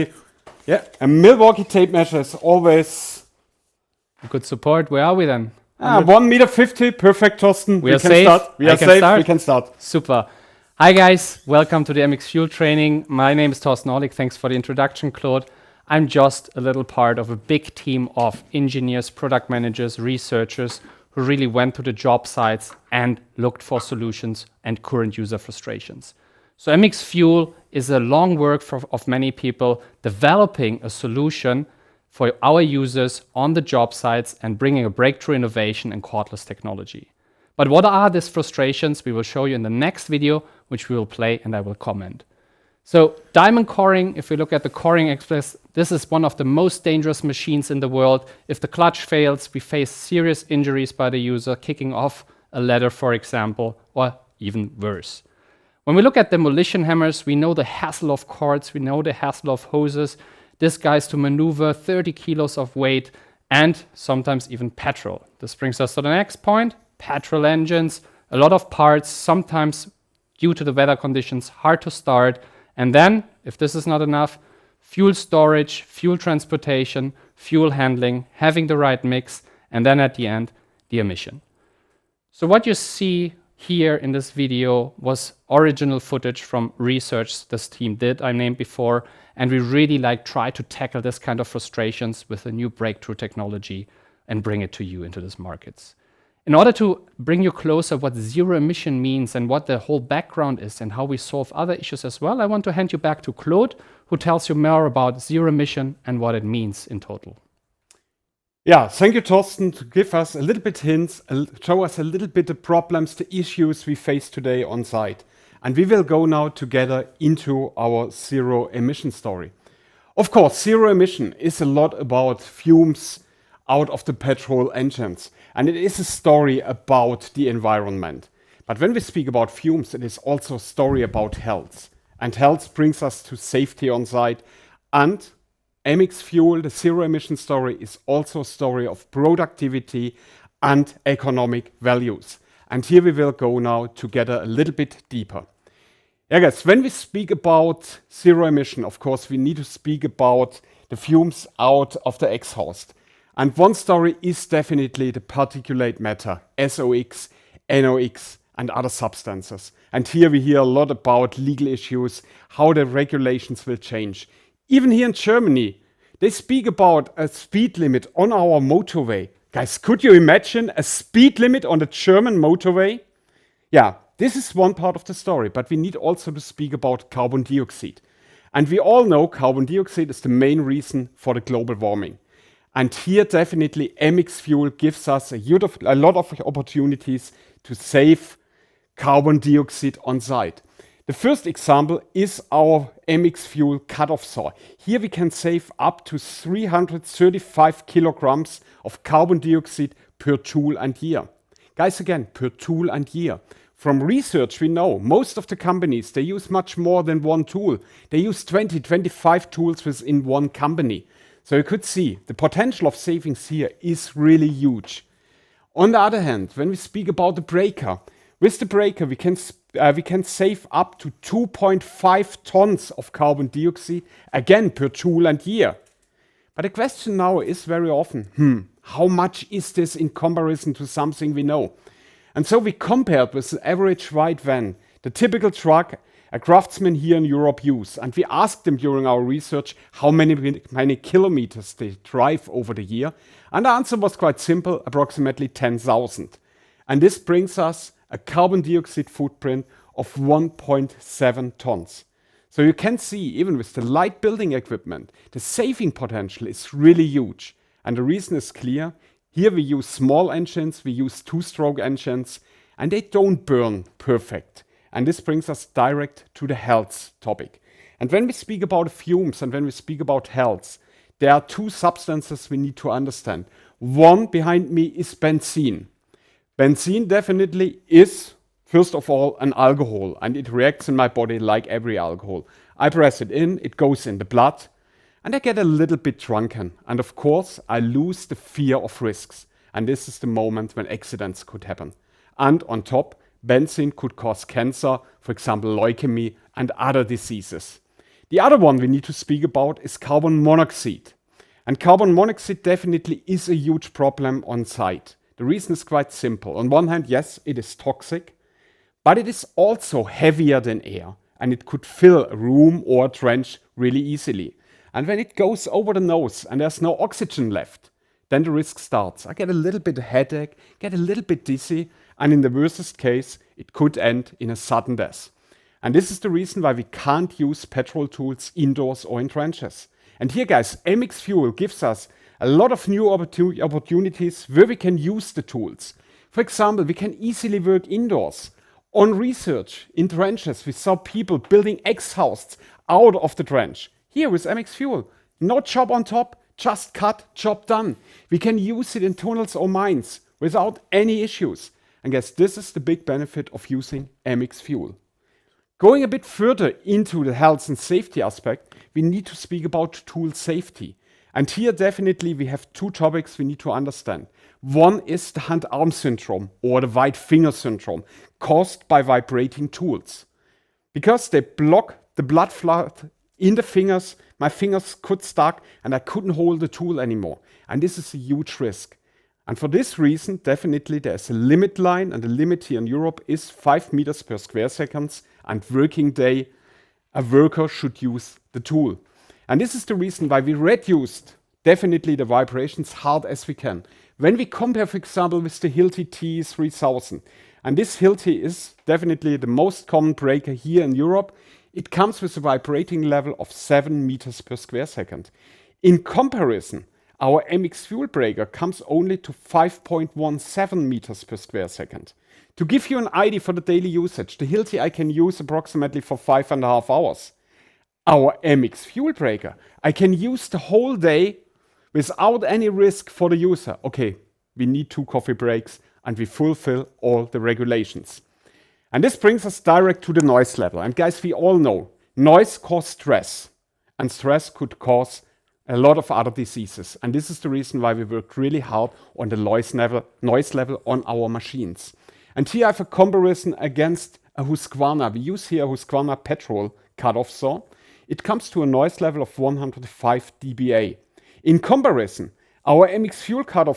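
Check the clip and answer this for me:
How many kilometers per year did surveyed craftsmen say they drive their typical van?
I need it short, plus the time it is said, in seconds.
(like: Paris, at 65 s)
10,000, at 245 s.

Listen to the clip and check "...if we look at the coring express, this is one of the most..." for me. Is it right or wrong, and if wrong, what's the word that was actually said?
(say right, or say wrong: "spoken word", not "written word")
right.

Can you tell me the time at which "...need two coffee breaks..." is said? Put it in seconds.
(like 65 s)
424 s.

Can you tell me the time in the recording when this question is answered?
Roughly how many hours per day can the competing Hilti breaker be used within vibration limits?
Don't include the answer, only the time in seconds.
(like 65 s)
416 s.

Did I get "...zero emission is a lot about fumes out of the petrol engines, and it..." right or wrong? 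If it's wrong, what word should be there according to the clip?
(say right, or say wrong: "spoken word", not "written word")
right.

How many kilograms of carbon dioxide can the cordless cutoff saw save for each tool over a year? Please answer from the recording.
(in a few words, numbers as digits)
335 kilograms.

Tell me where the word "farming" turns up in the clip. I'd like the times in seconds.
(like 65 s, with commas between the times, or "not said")
not said.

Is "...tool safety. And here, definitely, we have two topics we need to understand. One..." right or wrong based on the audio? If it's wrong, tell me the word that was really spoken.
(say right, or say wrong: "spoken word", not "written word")
right.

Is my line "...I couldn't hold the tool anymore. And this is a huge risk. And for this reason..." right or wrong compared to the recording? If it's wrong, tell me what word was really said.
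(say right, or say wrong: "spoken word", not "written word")
right.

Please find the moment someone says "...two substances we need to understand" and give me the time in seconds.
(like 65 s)
271 s.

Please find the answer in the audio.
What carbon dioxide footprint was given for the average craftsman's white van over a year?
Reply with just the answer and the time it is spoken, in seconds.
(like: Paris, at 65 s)
1.7 tons, at 250 s.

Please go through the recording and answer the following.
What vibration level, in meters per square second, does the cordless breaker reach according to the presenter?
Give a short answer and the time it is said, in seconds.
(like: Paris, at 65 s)
5.17, at 409 s.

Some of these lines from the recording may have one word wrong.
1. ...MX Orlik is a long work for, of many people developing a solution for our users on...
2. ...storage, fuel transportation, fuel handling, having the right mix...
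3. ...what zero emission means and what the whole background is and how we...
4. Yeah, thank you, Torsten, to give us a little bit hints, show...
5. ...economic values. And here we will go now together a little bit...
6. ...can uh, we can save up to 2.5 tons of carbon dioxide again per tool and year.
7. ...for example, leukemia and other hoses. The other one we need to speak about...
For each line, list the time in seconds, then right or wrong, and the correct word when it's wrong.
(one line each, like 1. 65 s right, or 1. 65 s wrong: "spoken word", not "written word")
1. 26 s wrong: "Fuel", not "Orlik"
2. 75 s right
3. 97 s right
4. 108 s right
5. 141 s right
6. 219 s right
7. 295 s wrong: "diseases", not "hoses".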